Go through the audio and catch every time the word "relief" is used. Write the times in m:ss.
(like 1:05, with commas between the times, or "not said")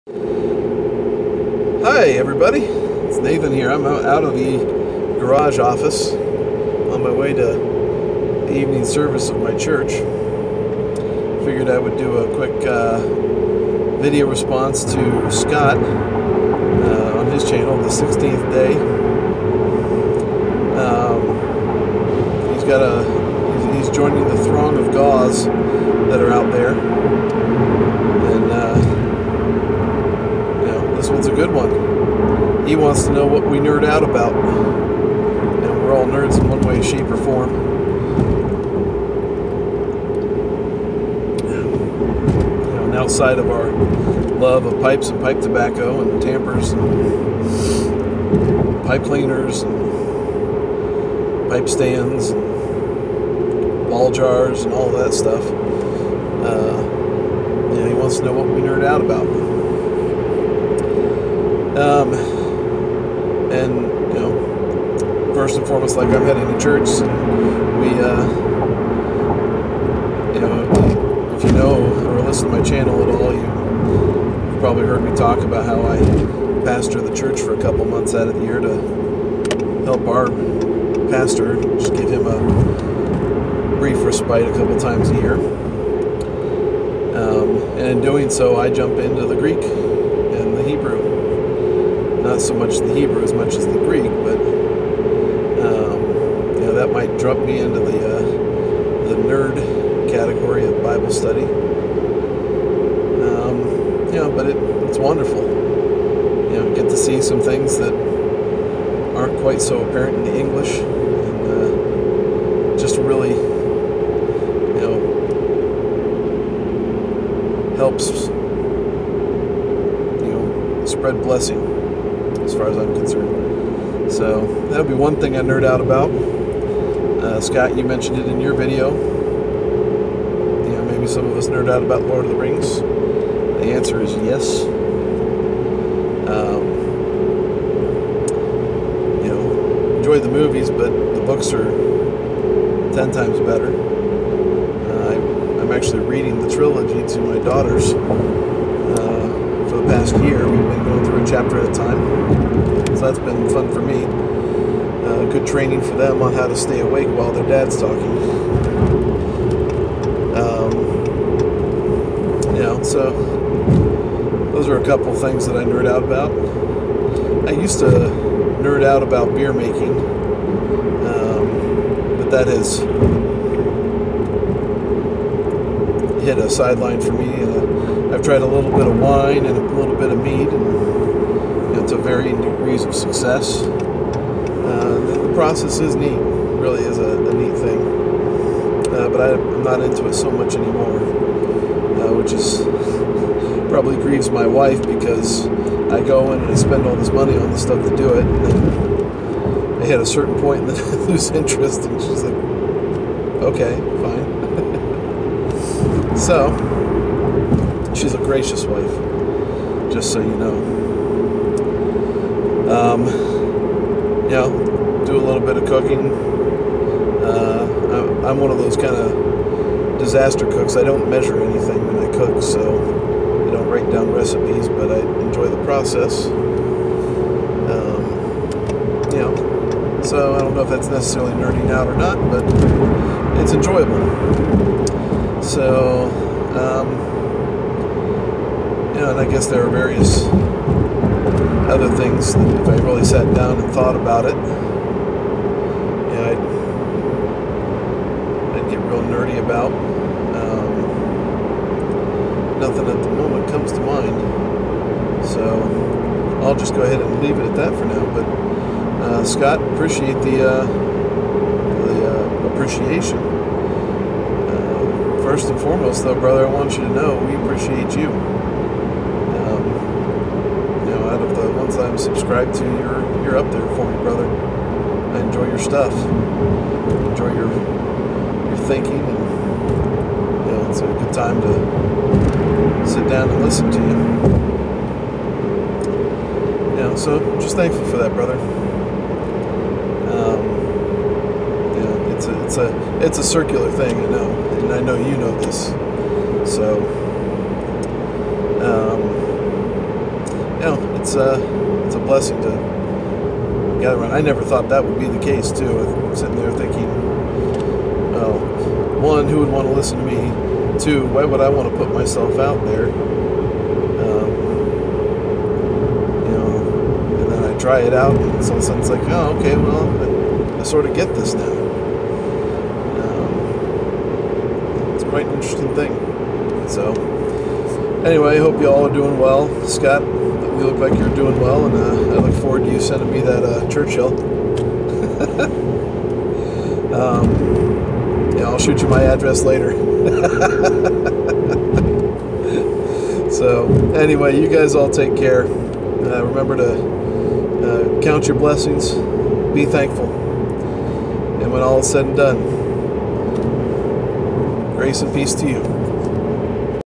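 not said.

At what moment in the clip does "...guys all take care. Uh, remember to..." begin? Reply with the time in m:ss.
5:44.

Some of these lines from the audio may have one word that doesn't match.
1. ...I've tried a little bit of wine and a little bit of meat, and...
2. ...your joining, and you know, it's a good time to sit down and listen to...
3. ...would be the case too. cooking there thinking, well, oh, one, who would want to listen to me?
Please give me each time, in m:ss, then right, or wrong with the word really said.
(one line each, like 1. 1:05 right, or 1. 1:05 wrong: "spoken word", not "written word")
1. 2:58 right
2. 4:37 wrong: "thinking", not "joining"
3. 5:04 wrong: "sitting", not "cooking".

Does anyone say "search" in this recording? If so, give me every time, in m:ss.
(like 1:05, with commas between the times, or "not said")
not said.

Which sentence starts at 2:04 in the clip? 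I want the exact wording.
So that'll be one thing I nerd out about.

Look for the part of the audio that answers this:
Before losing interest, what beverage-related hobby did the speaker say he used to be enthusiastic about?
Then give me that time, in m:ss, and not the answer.
2:49.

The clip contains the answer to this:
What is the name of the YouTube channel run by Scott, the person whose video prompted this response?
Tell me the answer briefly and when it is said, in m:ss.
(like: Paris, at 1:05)
The 16th Day, at 0:17.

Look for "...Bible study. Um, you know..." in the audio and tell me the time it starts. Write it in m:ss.
1:40.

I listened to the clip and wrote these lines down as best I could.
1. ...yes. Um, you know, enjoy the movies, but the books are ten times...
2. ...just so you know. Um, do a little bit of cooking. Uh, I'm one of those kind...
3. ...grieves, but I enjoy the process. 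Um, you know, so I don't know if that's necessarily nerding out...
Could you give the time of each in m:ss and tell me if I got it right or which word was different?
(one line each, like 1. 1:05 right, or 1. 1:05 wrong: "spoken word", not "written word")
1. 2:14 right
2. 3:29 right
3. 3:44 wrong: "recipes", not "grieves".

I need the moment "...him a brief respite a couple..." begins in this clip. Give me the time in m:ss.
1:22.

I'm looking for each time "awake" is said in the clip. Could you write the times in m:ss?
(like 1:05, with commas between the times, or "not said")
2:36.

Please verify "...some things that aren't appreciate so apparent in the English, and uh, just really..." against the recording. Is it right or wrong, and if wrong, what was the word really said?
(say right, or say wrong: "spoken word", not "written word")
wrong: "quite", not "appreciate".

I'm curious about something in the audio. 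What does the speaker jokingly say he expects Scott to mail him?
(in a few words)
Churchill.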